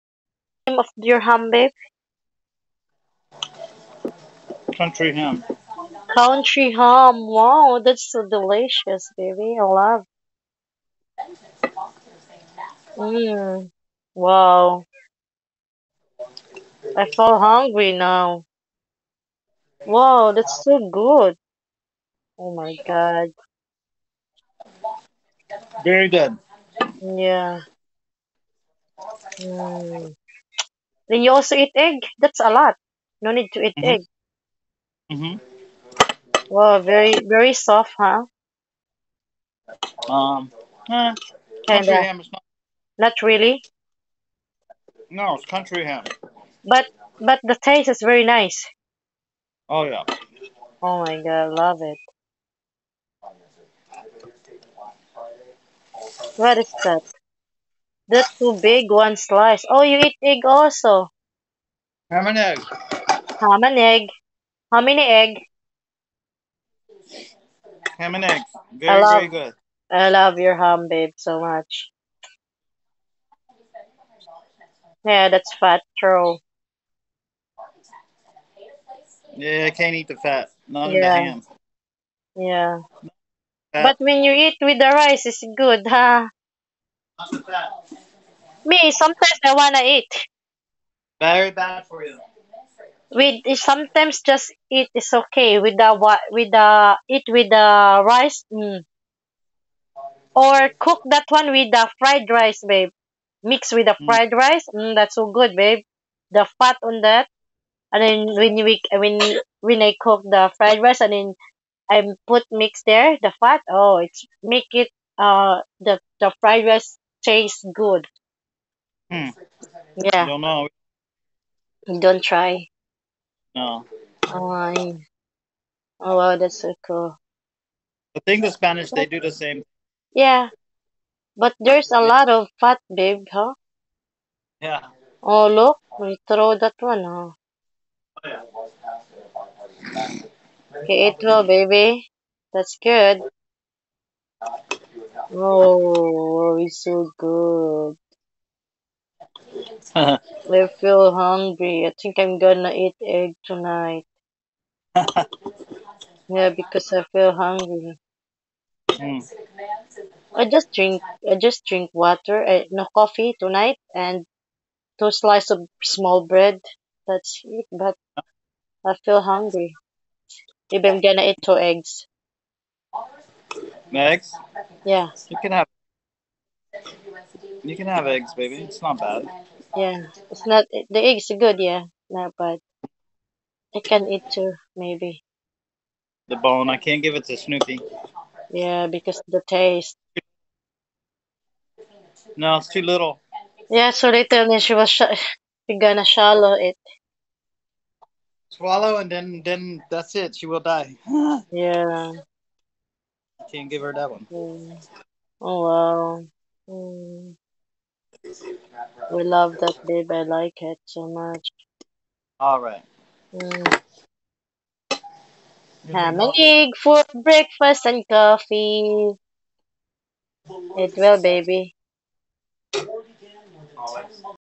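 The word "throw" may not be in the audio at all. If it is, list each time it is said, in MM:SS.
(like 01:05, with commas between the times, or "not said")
02:16.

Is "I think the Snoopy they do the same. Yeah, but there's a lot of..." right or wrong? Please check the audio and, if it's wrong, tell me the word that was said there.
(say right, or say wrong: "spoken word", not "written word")
wrong: "Spanish", not "Snoopy".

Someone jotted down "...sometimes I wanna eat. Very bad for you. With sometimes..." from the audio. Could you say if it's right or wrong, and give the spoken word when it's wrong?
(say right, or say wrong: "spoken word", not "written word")
right.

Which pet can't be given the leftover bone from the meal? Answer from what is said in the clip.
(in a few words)
Snoopy.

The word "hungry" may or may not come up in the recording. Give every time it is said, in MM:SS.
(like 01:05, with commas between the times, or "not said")
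00:17, 02:31, 02:37, 02:49.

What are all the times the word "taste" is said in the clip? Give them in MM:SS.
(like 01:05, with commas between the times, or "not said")
00:47, 01:57, 03:09.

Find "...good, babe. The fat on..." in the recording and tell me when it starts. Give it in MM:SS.
01:45.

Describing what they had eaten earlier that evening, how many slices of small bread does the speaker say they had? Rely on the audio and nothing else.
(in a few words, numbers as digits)
2.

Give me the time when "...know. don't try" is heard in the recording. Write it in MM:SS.
02:00.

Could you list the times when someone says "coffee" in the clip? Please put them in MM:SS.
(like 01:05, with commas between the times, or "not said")
02:42, 03:38.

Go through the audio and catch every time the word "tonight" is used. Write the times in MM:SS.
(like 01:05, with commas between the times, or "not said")
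02:33, 02:43.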